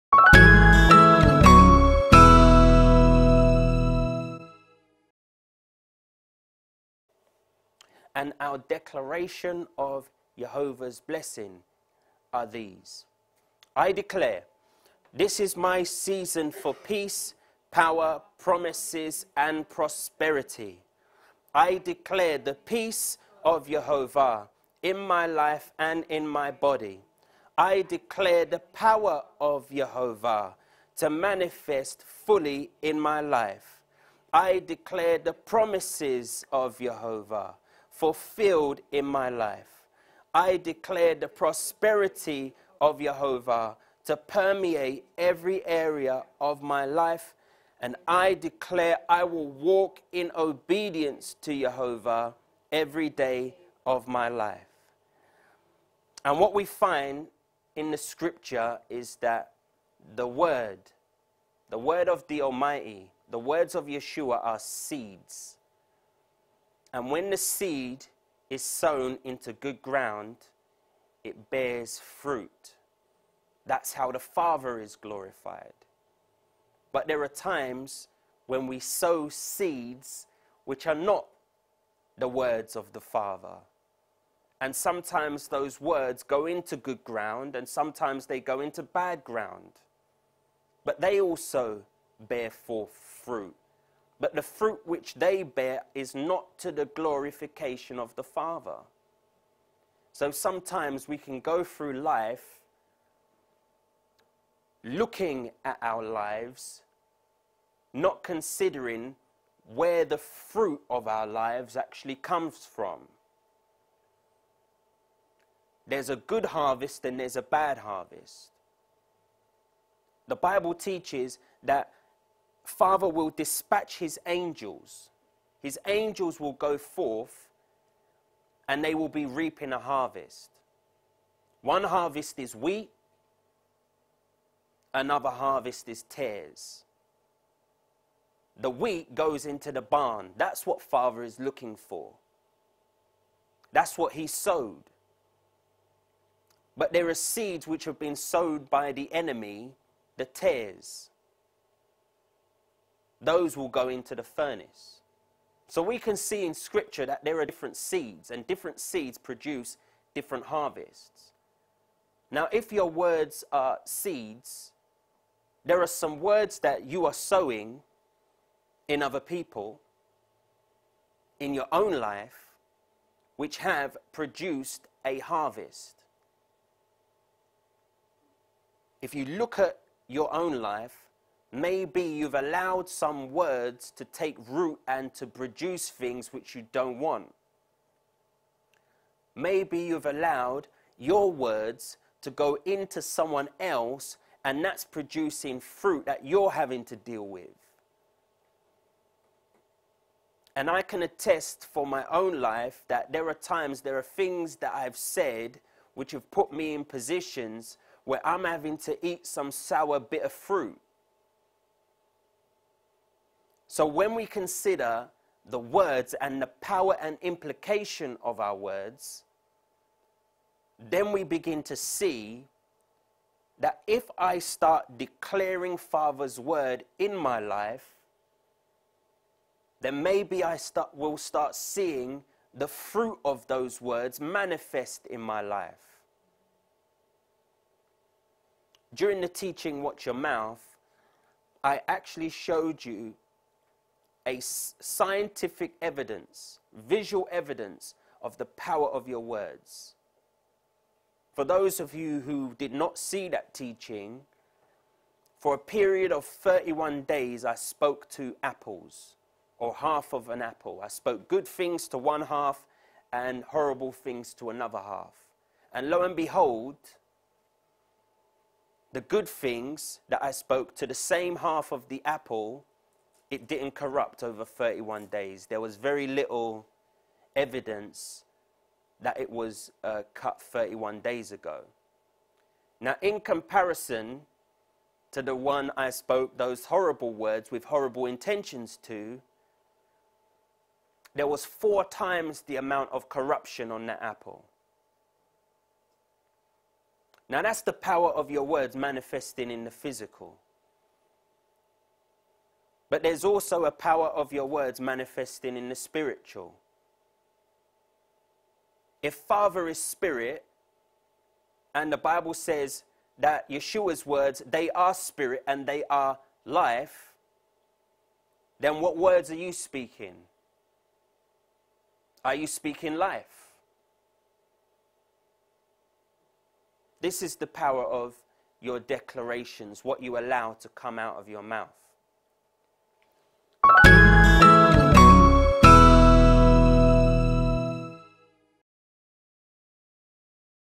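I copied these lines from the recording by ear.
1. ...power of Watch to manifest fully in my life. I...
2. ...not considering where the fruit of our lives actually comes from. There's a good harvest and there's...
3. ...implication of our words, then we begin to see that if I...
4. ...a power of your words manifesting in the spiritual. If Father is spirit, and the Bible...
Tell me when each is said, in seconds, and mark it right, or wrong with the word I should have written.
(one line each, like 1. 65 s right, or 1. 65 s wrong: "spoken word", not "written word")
1. 28 s wrong: "Jehovah", not "Watch"
2. 107 s right
3. 217 s right
4. 303 s right.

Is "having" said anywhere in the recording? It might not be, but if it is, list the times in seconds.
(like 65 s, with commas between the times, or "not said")
196 s, 208 s.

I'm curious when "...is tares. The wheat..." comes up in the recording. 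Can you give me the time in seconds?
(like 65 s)
135 s.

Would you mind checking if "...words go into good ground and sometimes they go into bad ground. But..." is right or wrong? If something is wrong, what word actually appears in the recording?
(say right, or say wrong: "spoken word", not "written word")
right.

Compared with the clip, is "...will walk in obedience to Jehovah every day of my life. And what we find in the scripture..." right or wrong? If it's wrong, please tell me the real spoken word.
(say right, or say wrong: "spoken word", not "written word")
right.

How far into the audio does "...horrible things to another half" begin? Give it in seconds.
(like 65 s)
263 s.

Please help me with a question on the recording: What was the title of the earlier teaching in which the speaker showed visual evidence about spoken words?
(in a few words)
Watch Your Mouth.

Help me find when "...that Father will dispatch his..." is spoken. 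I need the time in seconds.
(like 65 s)
121 s.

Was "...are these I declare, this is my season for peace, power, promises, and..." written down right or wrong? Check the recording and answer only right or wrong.
right.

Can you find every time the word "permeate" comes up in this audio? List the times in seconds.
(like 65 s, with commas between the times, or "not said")
44 s.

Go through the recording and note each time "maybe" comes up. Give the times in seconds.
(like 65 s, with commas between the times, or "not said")
181 s, 189 s, 230 s.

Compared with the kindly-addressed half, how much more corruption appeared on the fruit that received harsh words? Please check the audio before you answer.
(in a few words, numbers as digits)
Four times.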